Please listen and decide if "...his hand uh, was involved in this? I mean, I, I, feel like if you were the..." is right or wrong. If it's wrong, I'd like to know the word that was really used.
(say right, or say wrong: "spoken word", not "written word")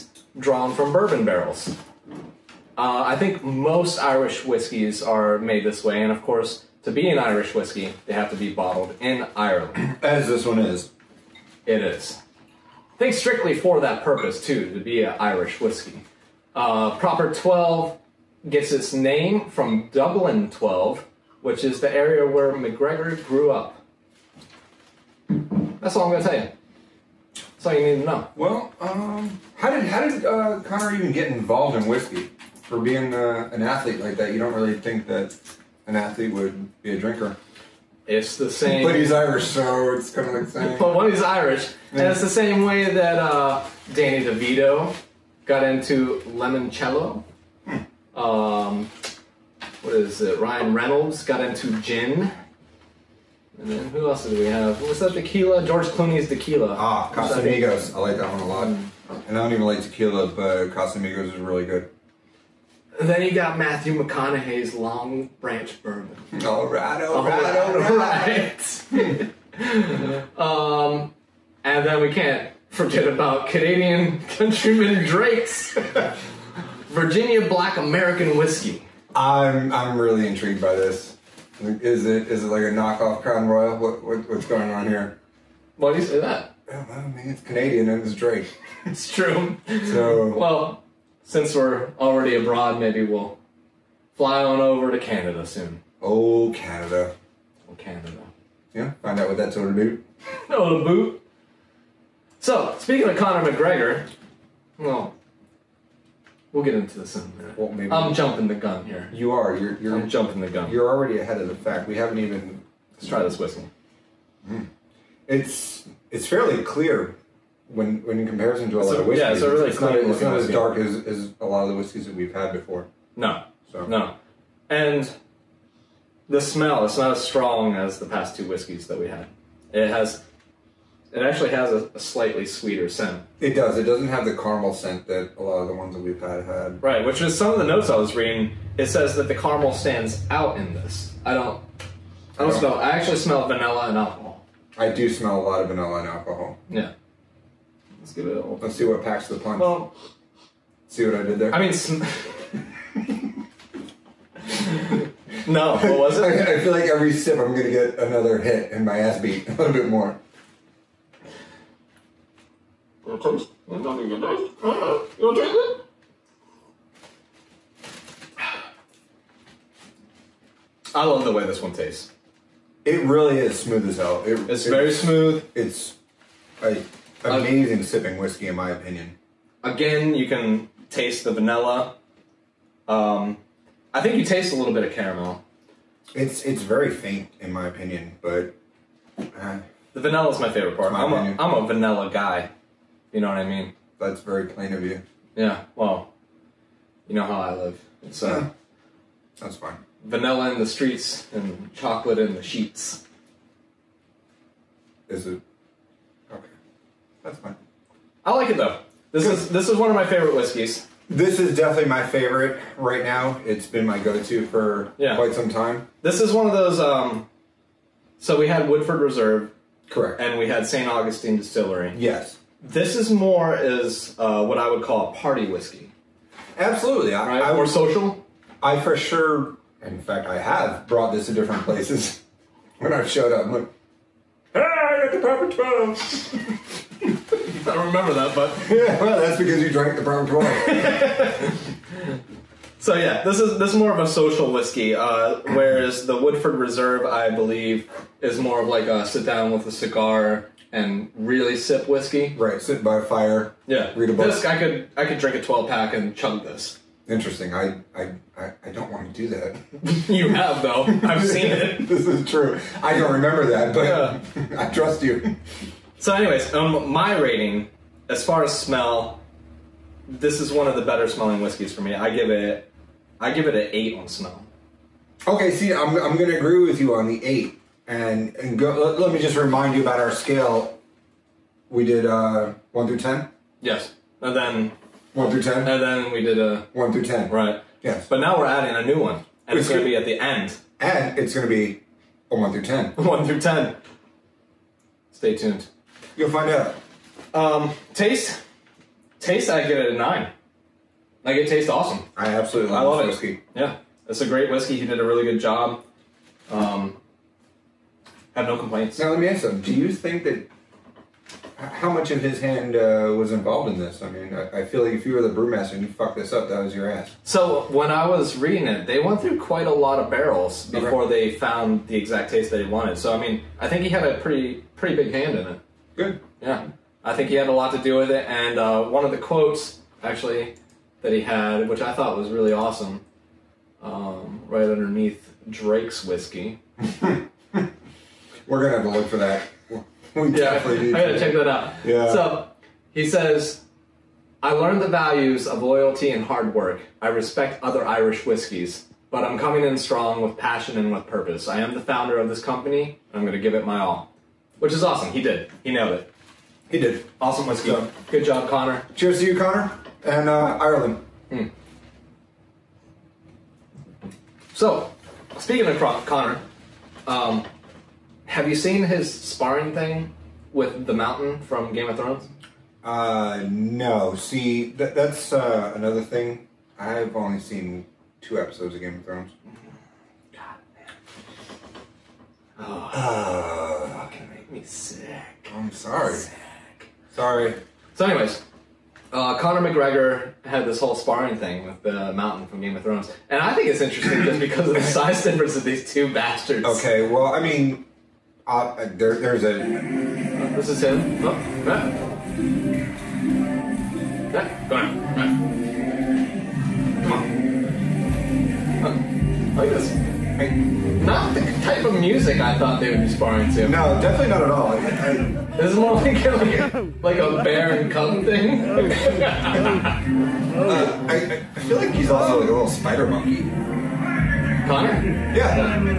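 right.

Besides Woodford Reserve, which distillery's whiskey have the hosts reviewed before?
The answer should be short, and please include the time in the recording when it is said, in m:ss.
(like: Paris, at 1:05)
St. Augustine Distillery, at 3:40.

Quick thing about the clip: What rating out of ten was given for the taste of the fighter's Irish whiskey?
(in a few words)
9.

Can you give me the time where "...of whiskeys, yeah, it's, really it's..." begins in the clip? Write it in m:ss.
1:58.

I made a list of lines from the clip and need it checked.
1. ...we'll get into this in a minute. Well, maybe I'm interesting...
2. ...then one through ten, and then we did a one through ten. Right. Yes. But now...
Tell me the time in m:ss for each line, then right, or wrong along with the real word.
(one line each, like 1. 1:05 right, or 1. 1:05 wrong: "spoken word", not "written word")
1. 1:46 wrong: "jumping", not "interesting"
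2. 4:44 right.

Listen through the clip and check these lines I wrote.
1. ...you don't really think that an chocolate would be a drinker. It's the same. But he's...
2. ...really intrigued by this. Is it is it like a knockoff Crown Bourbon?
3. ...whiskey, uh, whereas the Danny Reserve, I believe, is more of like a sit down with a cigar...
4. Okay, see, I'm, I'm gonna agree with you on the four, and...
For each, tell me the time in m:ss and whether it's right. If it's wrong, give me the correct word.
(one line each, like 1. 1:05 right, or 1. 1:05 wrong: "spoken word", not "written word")
1. 0:34 wrong: "athlete", not "chocolate"
2. 1:19 wrong: "Royal", not "Bourbon"
3. 4:04 wrong: "Woodford", not "Danny"
4. 4:35 wrong: "eight", not "four".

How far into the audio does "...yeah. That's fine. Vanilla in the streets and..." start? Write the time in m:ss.
3:18.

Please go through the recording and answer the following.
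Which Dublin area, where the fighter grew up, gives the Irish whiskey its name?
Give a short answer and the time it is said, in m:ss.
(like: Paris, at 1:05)
Dublin 12, at 0:19.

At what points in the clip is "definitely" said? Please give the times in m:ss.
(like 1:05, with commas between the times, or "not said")
3:31, 6:54.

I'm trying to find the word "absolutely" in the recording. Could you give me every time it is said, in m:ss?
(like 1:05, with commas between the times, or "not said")
3:46, 5:02.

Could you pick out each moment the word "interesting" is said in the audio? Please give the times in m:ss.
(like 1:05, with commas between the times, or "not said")
4:17, 6:33.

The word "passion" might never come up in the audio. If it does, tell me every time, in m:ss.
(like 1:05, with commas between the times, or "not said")
5:50.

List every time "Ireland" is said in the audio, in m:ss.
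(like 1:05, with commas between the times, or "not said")
0:09, 6:00.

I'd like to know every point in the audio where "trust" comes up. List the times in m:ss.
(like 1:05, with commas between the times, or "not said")
4:24.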